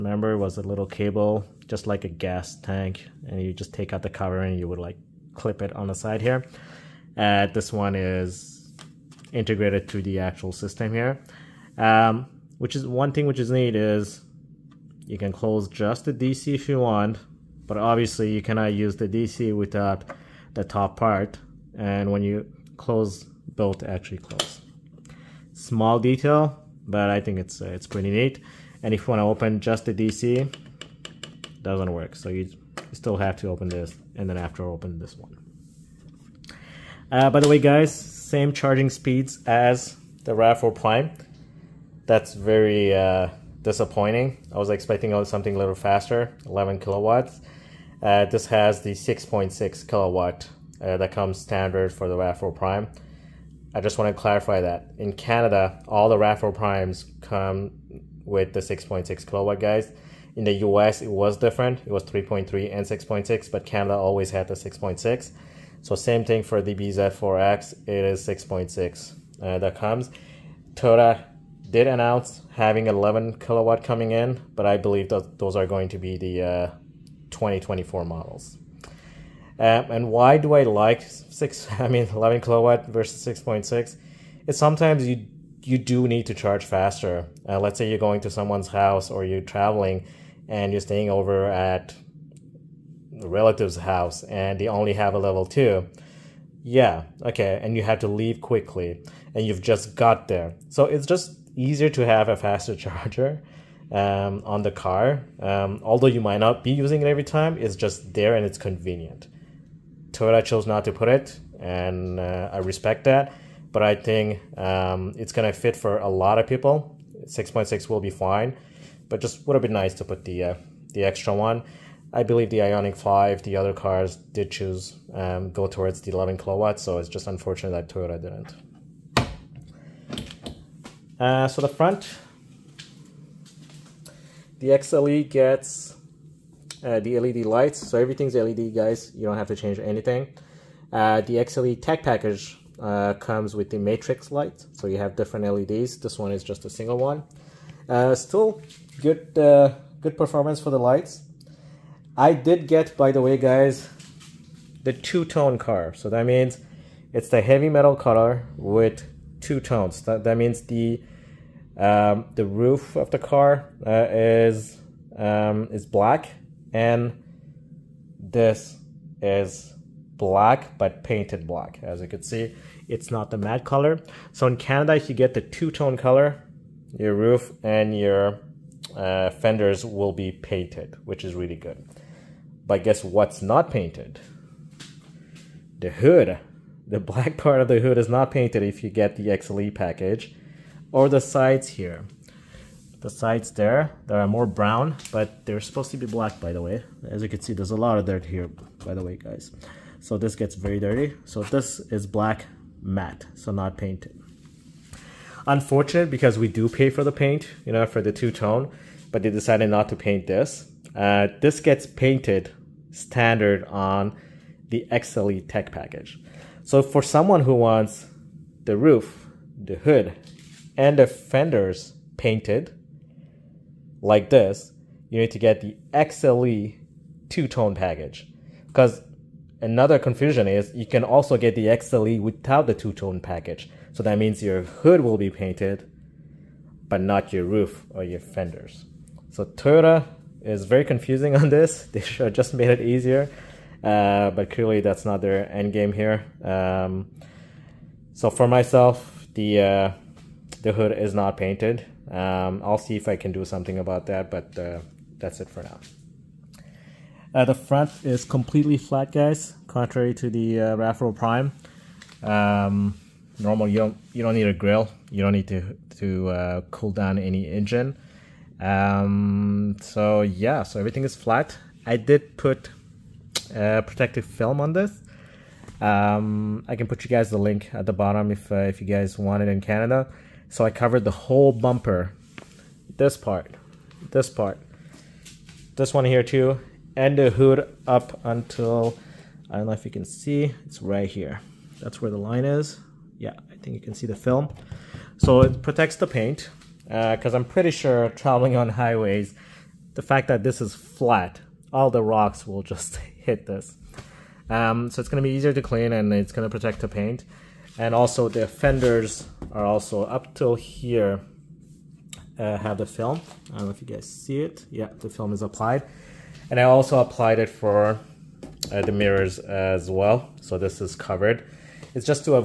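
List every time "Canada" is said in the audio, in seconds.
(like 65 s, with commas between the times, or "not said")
55 s, 63 s, 174 s, 279 s.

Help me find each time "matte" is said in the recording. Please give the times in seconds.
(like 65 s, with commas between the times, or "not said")
173 s, 202 s.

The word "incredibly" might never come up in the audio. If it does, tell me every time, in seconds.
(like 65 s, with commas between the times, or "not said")
not said.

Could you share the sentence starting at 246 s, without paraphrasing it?
Um, so for myself, the uh, the hood is not painted.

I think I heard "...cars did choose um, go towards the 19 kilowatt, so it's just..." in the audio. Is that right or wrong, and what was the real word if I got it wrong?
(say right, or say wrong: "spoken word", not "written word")
wrong: "11", not "19".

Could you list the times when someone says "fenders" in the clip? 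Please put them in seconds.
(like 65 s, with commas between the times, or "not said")
179 s, 221 s, 238 s, 308 s.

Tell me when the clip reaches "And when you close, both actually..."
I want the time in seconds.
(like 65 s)
21 s.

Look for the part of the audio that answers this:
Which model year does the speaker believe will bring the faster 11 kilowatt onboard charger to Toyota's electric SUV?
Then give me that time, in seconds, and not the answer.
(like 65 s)
77 s.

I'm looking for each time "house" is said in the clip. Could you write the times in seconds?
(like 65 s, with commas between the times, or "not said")
88 s, 93 s.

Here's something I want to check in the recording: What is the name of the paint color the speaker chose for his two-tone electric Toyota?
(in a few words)
Heavy metal.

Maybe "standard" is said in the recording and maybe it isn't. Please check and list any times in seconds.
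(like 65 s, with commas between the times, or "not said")
51 s, 212 s.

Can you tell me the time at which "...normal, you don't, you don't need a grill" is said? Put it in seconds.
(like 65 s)
263 s.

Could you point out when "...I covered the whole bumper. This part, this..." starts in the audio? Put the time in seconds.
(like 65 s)
280 s.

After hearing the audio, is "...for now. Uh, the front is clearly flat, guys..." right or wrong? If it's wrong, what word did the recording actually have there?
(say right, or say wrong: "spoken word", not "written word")
wrong: "completely", not "clearly".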